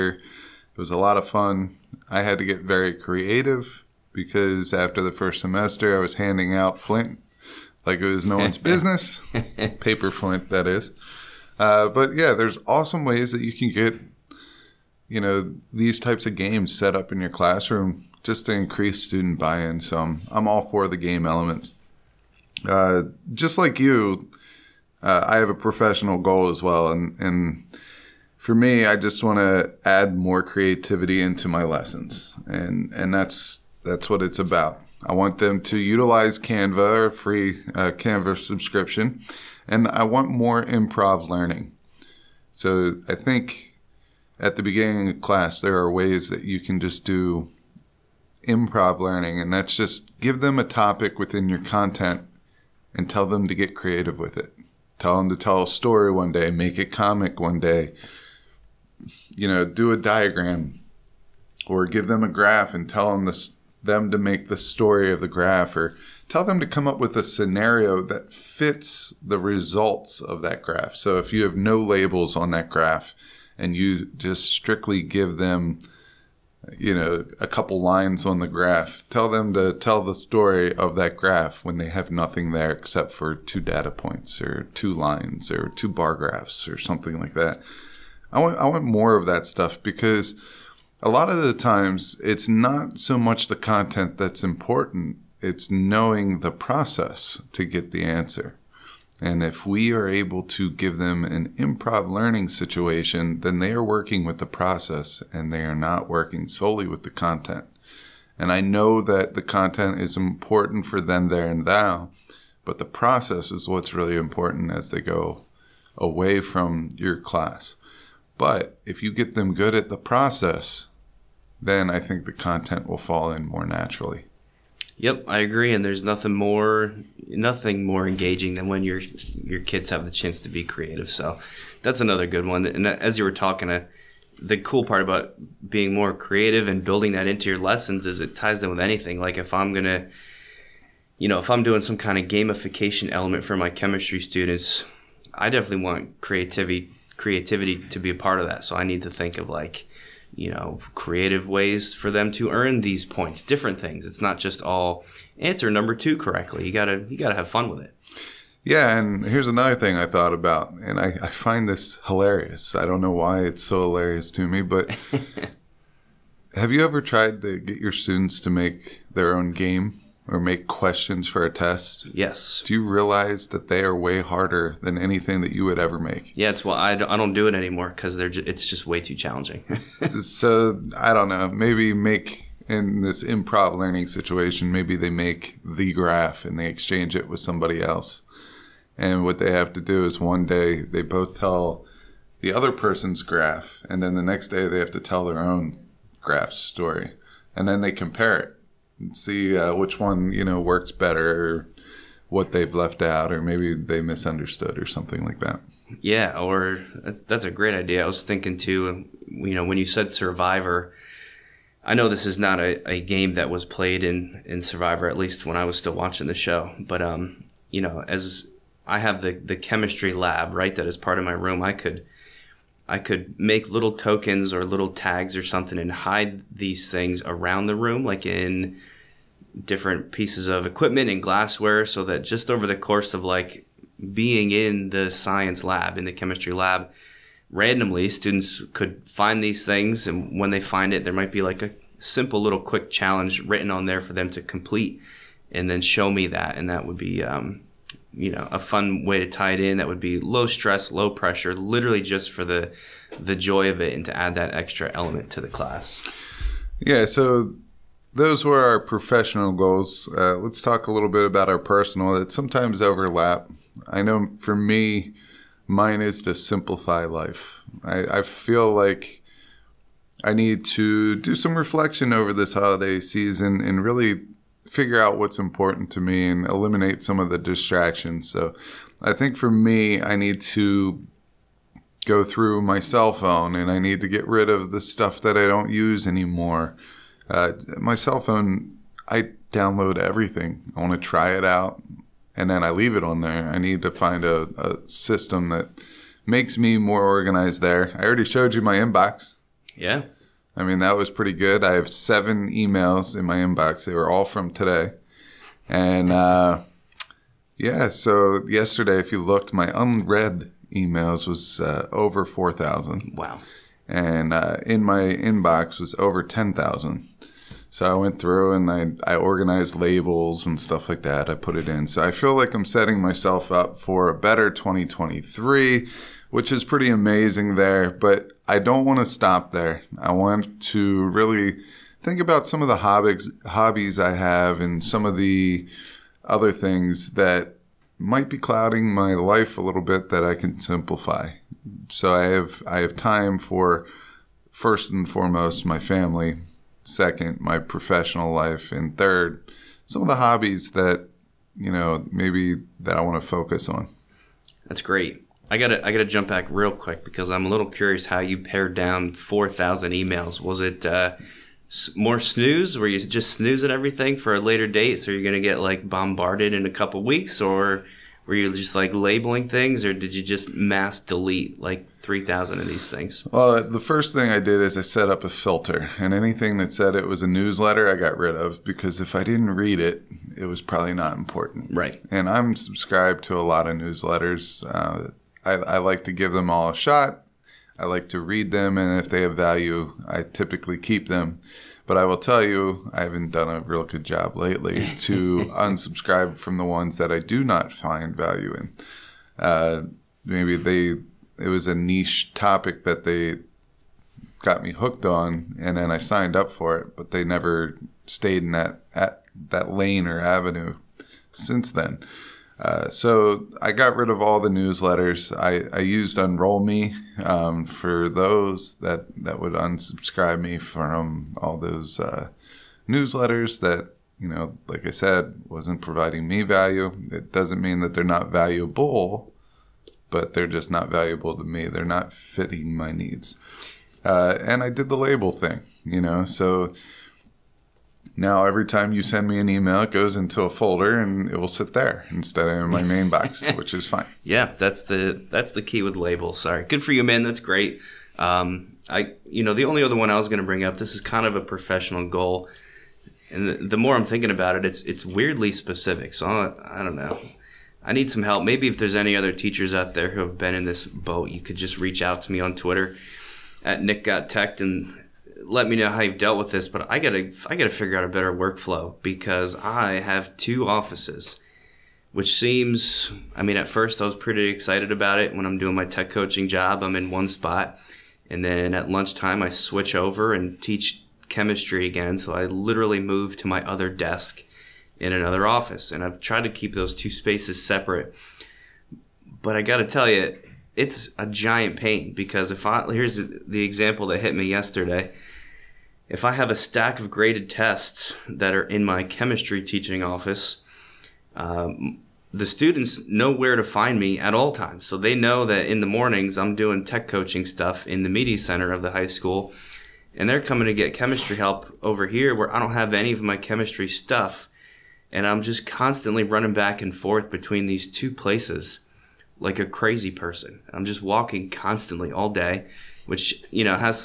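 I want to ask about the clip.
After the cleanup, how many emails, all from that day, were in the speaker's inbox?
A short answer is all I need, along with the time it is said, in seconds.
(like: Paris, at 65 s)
7, at 301 s.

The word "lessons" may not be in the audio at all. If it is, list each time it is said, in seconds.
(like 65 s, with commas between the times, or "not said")
31 s, 137 s.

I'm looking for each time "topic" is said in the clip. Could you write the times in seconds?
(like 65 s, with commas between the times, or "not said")
50 s, 402 s.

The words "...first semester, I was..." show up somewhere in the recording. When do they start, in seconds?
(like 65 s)
5 s.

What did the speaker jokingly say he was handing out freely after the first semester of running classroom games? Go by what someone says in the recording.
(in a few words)
paper Flint.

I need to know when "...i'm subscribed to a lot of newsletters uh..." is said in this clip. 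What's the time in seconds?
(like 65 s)
382 s.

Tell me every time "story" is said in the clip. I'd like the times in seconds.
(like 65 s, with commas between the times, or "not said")
55 s, 64 s, 80 s, 196 s.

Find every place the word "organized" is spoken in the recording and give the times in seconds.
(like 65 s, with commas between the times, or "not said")
297 s, 319 s.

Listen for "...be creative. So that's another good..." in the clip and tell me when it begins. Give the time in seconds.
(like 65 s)
130 s.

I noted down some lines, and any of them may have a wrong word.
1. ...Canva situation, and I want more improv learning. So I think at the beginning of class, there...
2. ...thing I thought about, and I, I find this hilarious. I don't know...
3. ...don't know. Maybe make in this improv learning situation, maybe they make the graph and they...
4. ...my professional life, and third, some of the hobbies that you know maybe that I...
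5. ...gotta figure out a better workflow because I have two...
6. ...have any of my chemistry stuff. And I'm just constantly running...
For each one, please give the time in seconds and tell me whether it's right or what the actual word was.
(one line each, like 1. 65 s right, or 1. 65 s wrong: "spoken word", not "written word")
1. 37 s wrong: "subscription", not "situation"
2. 159 s right
3. 181 s right
4. 347 s right
5. 467 s right
6. 512 s right.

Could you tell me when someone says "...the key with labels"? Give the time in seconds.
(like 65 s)
445 s.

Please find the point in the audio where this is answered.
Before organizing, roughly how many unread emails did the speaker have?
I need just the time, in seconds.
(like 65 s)
311 s.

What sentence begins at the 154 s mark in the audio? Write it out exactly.
It's not just all answer number two correctly.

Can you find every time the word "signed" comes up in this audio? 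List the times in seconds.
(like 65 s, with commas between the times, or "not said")
405 s.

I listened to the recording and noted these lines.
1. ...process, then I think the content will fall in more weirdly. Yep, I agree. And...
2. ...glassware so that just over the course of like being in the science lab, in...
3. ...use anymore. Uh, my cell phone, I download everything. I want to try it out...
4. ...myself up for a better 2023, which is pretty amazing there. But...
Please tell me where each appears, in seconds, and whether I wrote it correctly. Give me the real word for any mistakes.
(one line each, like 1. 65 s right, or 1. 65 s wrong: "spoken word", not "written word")
1. 119 s wrong: "naturally", not "weirdly"
2. 231 s right
3. 285 s right
4. 323 s right.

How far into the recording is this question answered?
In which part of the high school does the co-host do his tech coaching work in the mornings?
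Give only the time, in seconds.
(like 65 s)
508 s.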